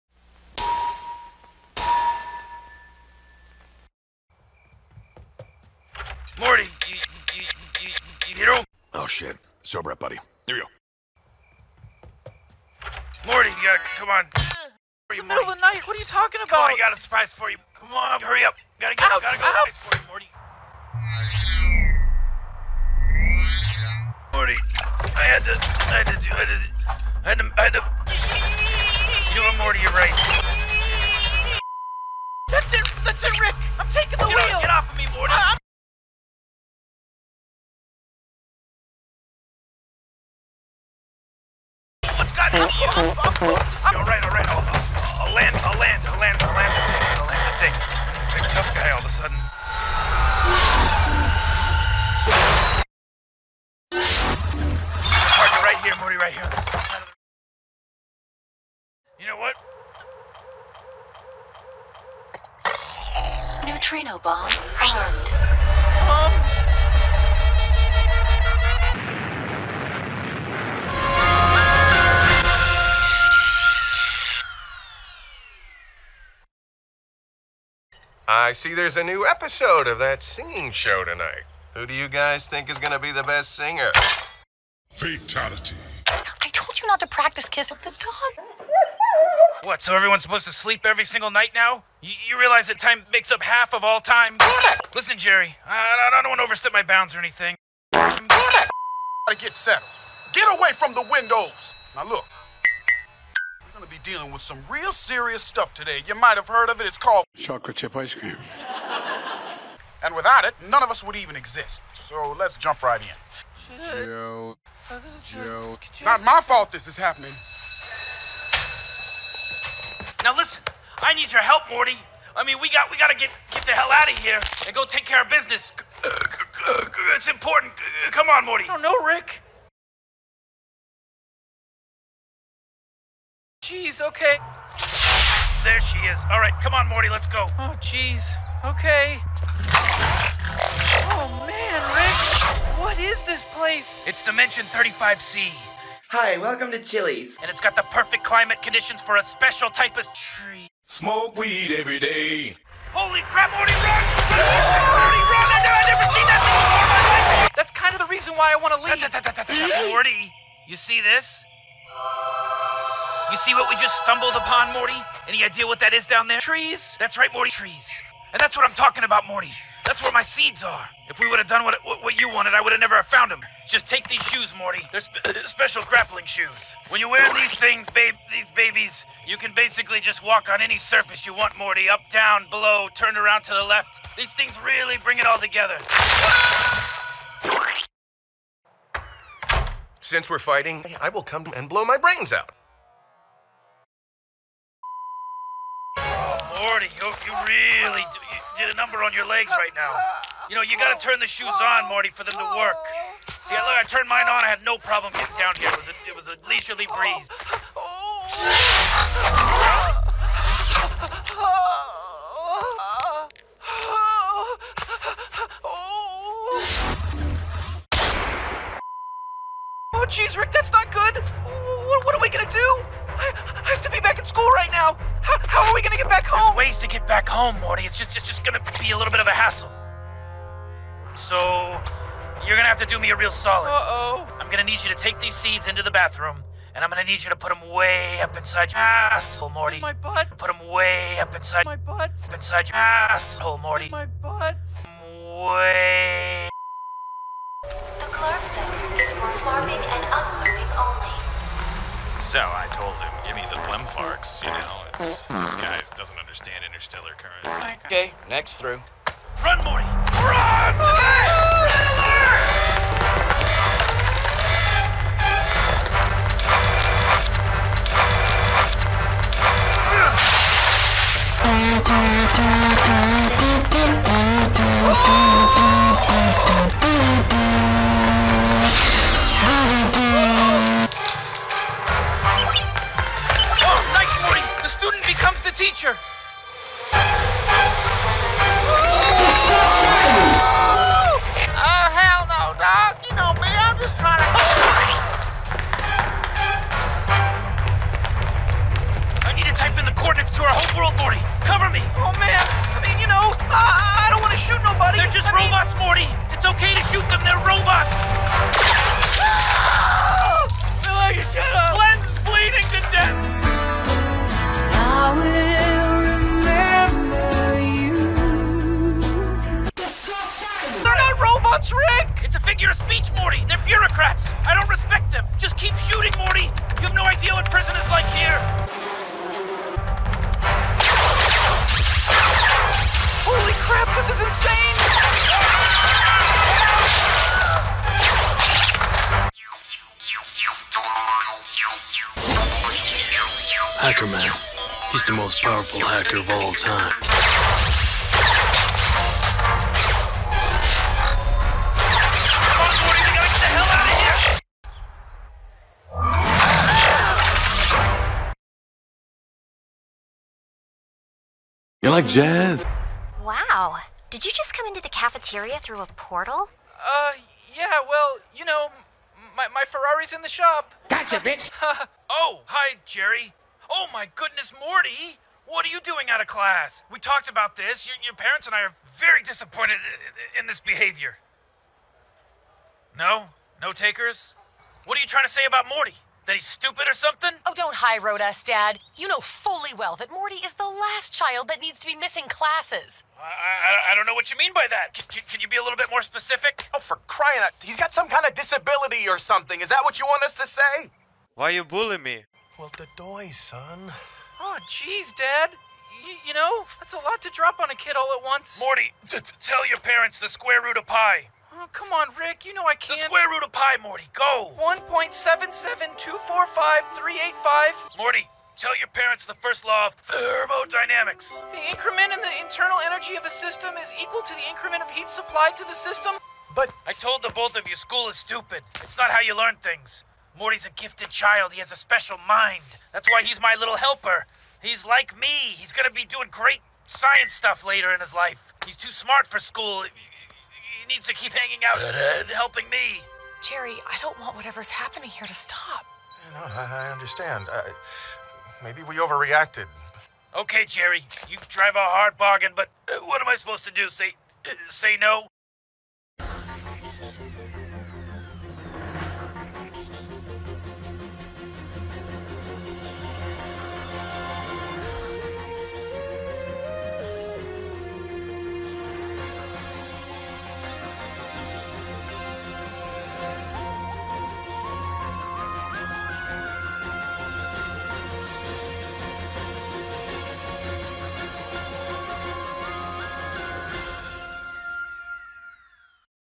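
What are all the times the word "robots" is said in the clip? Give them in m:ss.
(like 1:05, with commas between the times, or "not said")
5:07, 5:21.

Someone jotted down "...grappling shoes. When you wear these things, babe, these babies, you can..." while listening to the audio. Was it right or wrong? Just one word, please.
right.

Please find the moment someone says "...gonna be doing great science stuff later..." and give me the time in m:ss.
7:15.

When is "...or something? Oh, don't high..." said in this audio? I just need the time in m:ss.
6:26.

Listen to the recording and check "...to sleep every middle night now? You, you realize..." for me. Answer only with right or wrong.
wrong.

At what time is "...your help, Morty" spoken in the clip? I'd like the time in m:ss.
2:01.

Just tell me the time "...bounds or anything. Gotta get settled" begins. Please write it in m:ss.
1:36.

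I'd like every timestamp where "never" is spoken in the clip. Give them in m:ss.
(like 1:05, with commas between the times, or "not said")
2:35, 2:52.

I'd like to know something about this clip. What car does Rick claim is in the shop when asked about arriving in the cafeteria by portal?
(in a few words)
Ferrari.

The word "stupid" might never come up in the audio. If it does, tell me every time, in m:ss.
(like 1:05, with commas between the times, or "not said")
6:26, 7:08.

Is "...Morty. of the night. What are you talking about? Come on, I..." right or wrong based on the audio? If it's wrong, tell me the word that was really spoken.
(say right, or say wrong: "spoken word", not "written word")
right.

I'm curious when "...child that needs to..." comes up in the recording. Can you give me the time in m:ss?
6:31.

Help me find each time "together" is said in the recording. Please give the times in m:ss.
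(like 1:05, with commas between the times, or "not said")
3:05.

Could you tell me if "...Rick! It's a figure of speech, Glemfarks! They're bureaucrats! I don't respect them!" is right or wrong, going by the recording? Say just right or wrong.
wrong.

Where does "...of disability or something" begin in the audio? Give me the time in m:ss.
6:38.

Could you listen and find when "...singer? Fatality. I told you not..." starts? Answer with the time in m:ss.
1:23.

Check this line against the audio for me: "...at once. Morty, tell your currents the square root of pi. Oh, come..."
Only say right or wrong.
wrong.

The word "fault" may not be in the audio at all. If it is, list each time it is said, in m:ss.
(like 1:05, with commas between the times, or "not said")
1:56.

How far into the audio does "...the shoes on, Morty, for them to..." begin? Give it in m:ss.
3:21.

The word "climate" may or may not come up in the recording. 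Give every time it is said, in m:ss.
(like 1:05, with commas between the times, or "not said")
2:28.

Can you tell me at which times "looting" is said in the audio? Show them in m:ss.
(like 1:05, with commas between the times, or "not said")
not said.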